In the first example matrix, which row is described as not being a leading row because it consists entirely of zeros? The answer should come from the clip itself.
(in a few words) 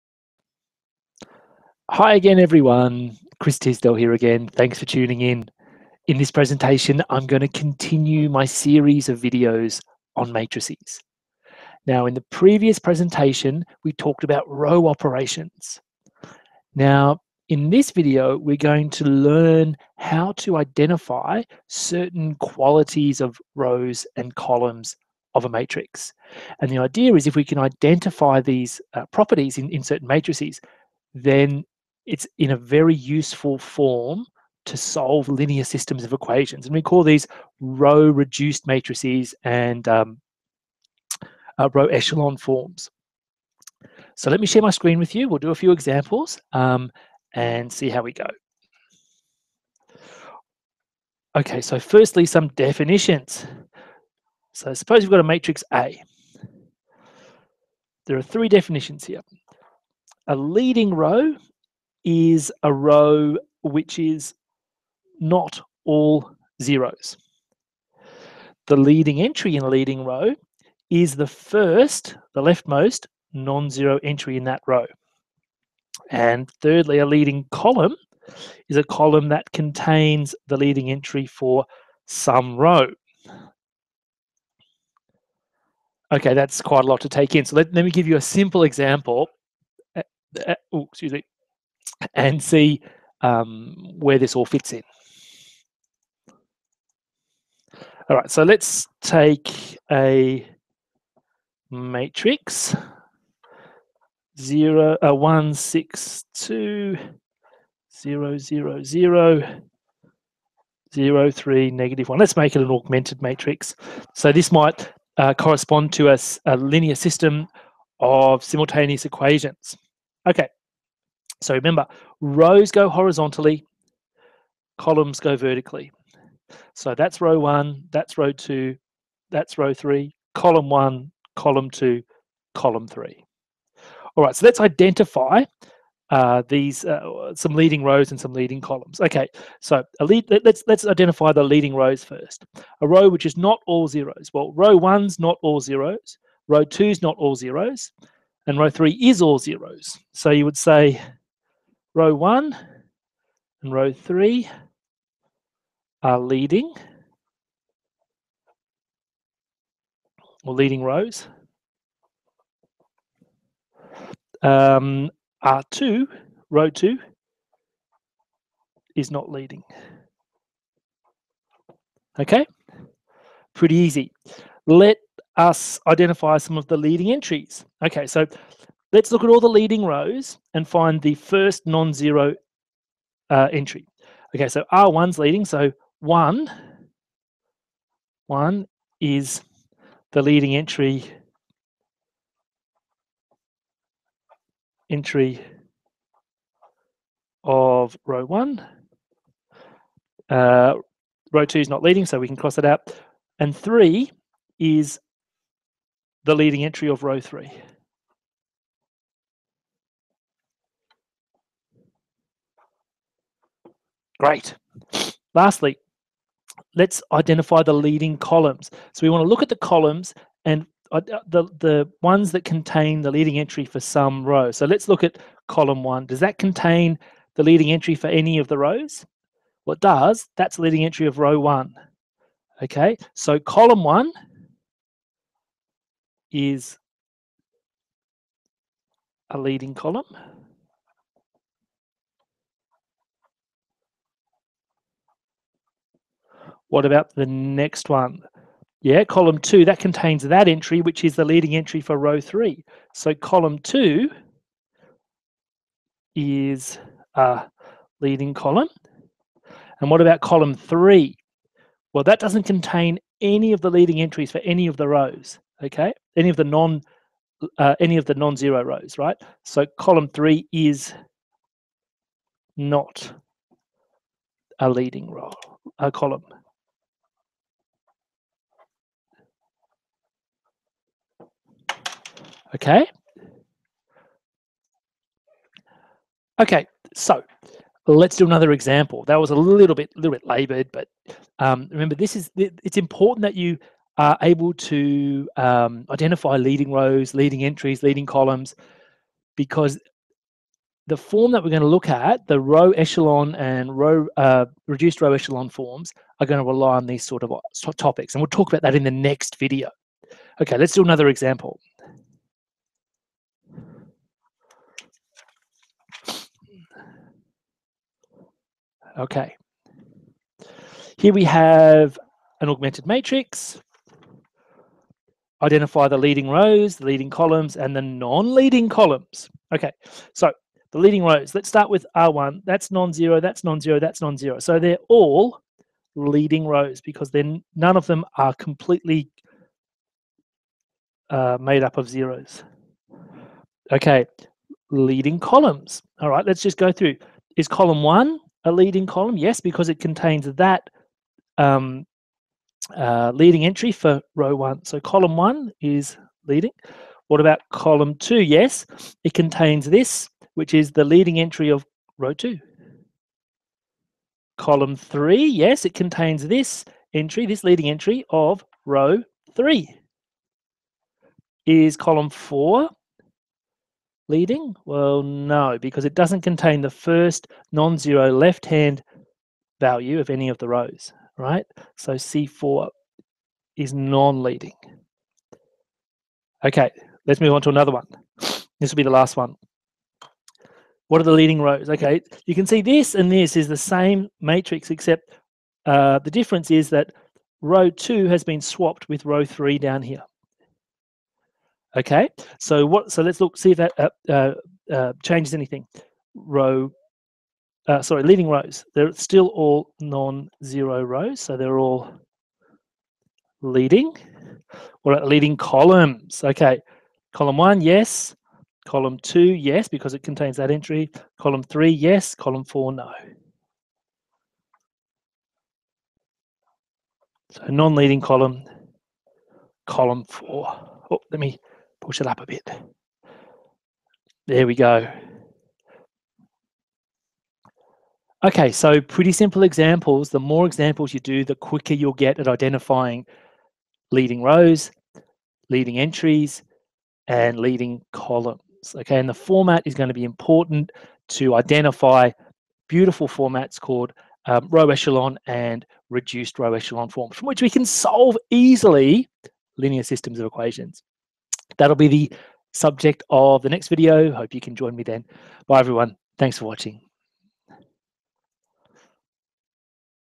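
Row 2.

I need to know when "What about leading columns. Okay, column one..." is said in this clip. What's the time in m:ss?
6:54.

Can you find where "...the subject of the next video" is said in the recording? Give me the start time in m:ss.
7:41.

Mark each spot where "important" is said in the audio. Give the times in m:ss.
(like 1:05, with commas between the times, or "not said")
4:52, 7:30.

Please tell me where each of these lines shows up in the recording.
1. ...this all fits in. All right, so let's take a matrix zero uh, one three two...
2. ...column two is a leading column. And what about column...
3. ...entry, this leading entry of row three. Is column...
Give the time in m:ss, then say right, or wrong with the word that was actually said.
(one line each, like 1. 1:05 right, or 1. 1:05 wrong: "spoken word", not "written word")
1. 1:34 wrong: "six", not "three"
2. 4:13 right
3. 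6:06 right.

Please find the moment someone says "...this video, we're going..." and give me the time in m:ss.
0:17.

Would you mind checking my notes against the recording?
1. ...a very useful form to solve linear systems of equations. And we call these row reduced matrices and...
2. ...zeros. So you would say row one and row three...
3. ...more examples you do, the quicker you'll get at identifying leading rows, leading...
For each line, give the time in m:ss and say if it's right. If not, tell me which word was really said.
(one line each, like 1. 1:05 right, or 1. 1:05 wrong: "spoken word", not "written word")
1. 0:32 right
2. 2:29 right
3. 7:20 right.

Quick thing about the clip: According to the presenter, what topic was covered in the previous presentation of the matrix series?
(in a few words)
Row operations.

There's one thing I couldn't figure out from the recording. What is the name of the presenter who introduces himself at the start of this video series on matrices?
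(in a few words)
Chris Tisdell.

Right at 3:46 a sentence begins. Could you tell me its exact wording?
Does that contain the leading entry for any of the rows?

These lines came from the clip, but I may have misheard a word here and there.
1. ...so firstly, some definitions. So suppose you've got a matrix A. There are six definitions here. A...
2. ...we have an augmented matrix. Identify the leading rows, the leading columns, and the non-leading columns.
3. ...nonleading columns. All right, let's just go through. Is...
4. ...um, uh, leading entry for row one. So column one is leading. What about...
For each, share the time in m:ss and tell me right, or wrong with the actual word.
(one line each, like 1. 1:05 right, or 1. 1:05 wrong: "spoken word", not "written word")
1. 0:51 wrong: "three", not "six"
2. 5:21 right
3. 5:44 wrong: "leading", not "nonleading"
4. 5:51 right.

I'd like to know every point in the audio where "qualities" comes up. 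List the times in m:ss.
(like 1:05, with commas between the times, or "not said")
0:22.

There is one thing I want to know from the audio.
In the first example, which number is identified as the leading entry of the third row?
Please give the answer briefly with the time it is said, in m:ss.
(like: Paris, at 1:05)
3, at 3:23.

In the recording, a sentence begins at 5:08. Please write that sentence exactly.
And we'll talk about that in the next video.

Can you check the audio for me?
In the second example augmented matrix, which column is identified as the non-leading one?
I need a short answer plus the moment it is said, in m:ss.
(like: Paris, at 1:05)
Column 4, at 6:21.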